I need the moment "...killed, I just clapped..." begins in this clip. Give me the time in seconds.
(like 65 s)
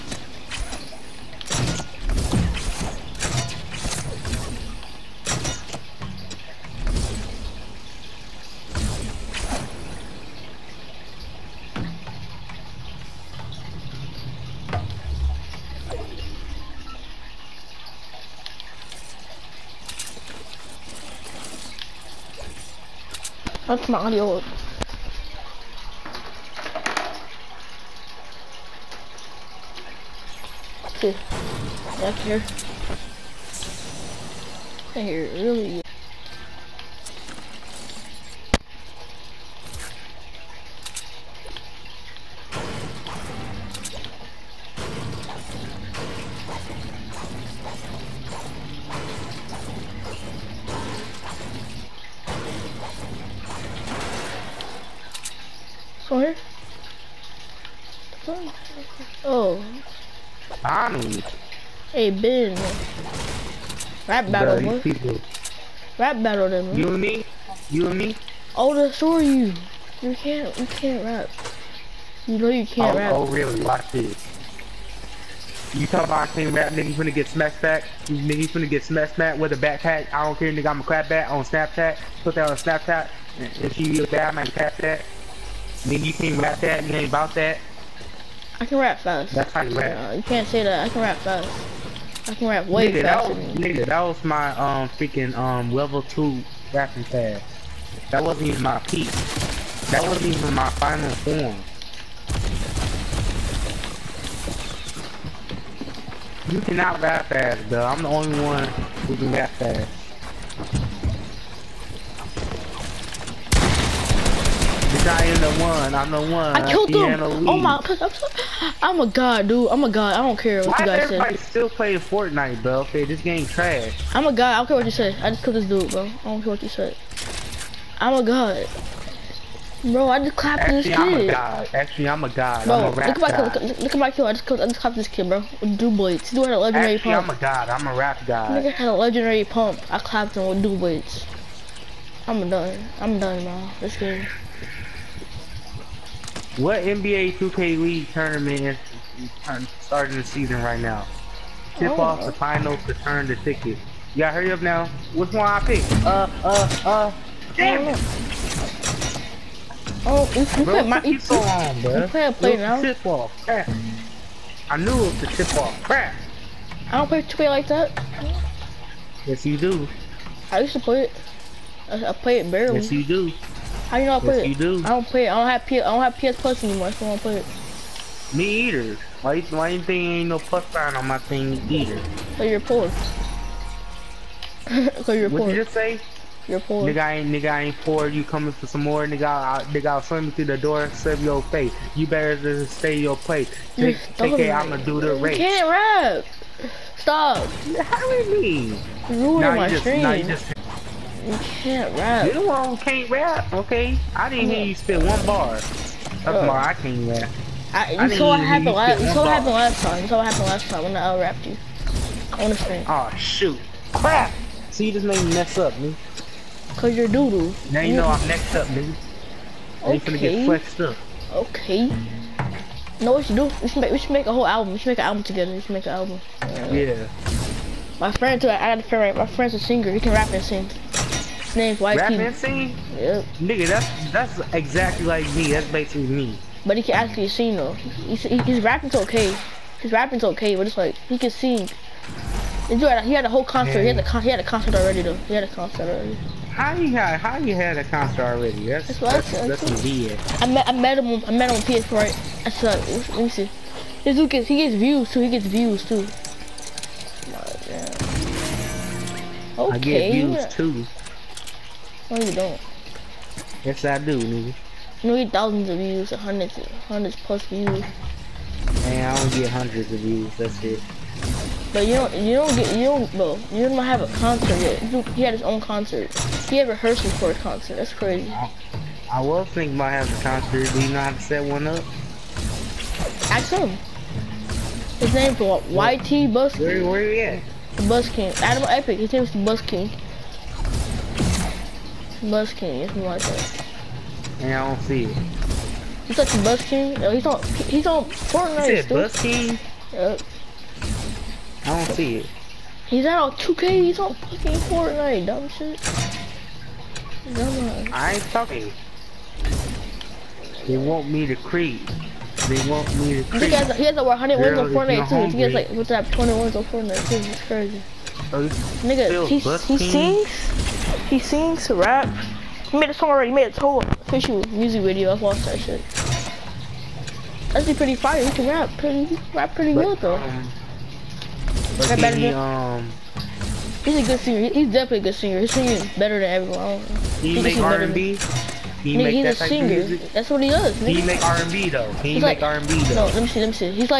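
134 s.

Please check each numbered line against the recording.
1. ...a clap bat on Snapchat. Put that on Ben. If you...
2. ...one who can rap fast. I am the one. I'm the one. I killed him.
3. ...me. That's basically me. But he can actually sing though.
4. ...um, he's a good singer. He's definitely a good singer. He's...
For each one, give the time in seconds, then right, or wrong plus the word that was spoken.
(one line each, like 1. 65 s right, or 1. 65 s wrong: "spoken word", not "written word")
1. 80 s wrong: "Snapchat", not "Ben"
2. 108 s right
3. 235 s right
4. 332 s right.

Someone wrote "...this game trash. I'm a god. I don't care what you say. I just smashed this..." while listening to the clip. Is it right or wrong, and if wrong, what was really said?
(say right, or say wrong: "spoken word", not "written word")
wrong: "killed", not "smashed".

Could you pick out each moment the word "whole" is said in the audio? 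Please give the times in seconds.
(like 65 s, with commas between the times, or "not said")
224 s, 243 s, 323 s.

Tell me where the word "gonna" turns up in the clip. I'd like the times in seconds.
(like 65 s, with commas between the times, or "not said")
84 s.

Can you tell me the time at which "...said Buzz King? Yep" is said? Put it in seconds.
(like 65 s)
298 s.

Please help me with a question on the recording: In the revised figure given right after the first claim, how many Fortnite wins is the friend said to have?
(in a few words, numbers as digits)
20.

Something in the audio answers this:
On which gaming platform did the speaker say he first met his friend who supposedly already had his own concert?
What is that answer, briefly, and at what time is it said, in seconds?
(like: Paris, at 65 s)
PS4, at 251 s.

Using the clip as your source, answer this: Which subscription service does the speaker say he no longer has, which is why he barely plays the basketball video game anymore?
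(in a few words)
PS Plus.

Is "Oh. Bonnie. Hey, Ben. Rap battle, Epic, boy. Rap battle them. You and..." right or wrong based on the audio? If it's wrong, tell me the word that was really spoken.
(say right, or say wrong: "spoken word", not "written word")
wrong: "Bro", not "Epic".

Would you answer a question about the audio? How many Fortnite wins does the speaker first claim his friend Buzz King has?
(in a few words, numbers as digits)
over 100.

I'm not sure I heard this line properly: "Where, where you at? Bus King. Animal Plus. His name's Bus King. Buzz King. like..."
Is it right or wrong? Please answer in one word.
wrong.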